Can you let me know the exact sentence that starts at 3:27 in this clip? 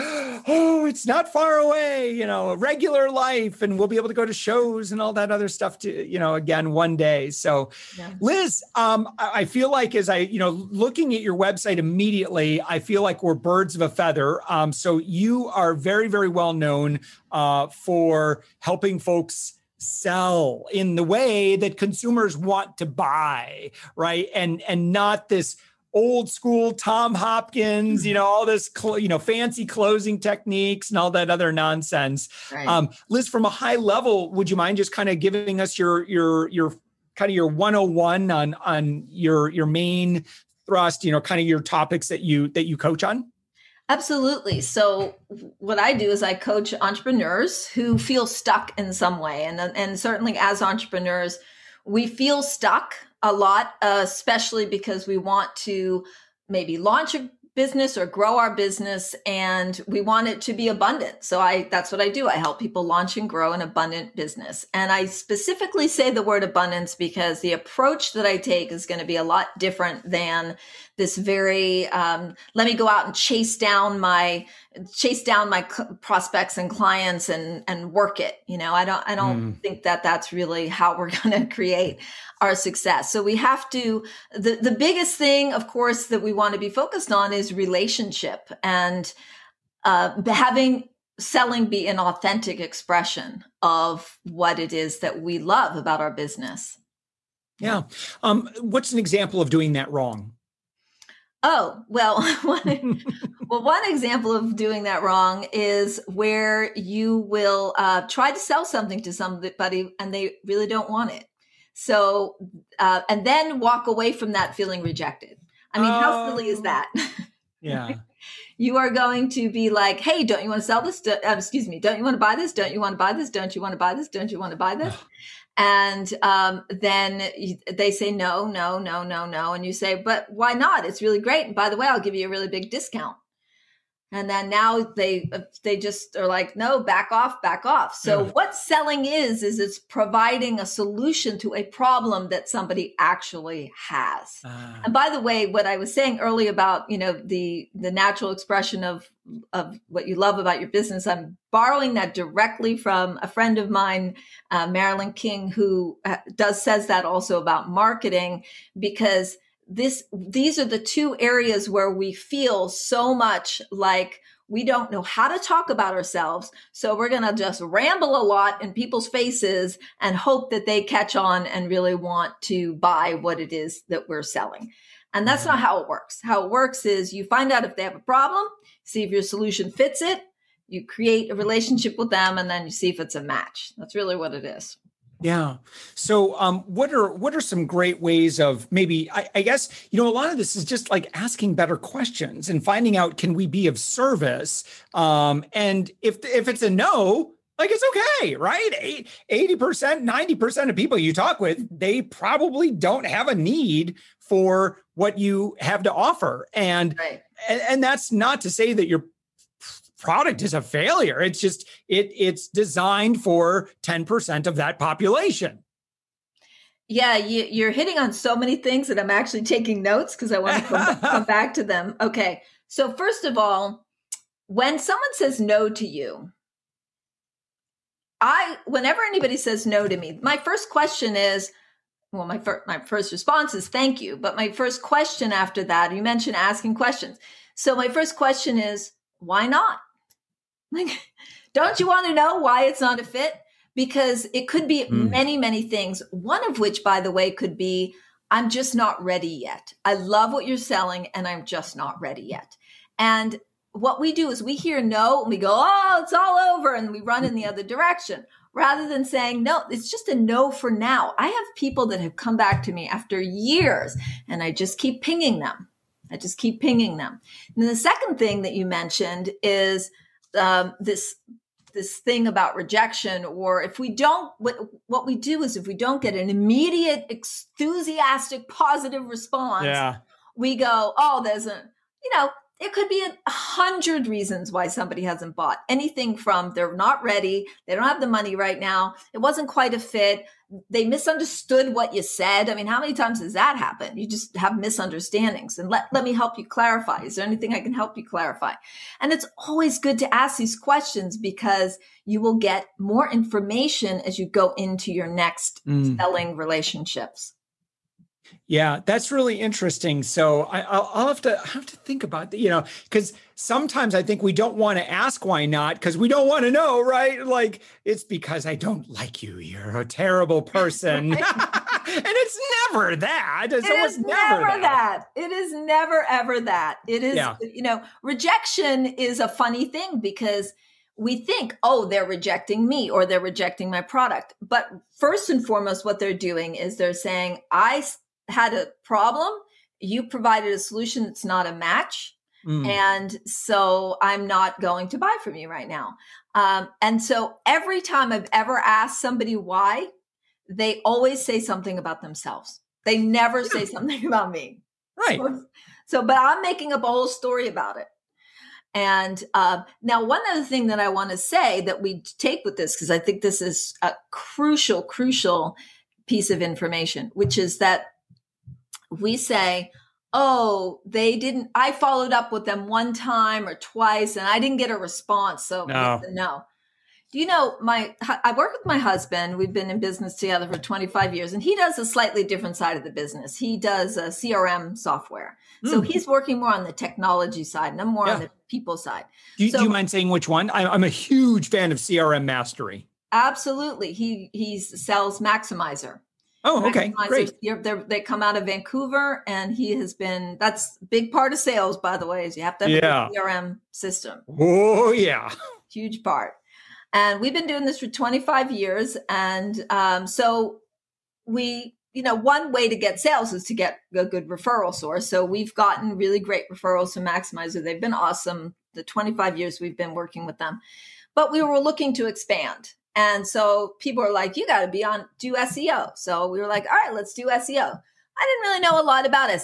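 and, and that's not to say that you're product is a failure.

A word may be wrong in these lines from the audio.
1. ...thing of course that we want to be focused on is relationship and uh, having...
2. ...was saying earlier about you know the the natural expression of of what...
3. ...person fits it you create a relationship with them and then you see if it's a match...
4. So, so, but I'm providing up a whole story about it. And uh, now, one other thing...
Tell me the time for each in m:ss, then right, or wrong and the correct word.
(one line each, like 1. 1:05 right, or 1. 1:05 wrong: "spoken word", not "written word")
1. 1:25 right
2. 2:25 right
3. 2:59 wrong: "solution", not "person"
4. 5:55 wrong: "making", not "providing".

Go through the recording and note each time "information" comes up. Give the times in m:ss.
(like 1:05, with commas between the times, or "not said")
5:03, 6:06.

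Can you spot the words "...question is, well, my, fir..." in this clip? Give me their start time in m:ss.
3:50.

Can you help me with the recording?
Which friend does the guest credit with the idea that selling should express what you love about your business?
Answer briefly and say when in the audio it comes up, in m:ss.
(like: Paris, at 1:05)
Marilyn King, at 2:34.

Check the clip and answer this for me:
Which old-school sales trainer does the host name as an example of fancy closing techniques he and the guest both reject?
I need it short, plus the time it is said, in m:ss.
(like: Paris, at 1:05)
Tom Hopkins, at 0:26.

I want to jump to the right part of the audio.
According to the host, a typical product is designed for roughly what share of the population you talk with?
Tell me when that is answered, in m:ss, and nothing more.
3:33.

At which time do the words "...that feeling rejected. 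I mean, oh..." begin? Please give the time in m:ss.
1:54.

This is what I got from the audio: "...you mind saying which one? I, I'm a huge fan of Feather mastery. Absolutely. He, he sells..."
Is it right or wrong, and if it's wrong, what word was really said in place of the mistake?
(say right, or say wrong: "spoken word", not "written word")
wrong: "CRM", not "Feather".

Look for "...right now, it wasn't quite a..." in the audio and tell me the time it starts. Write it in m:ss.
4:48.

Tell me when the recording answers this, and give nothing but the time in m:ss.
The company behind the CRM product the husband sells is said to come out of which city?
6:38.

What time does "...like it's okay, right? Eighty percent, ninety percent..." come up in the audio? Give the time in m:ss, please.
3:17.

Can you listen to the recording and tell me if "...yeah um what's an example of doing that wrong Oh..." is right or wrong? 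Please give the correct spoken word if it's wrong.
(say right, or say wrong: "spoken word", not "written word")
right.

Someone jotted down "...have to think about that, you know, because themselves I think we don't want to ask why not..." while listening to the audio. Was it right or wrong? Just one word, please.
wrong.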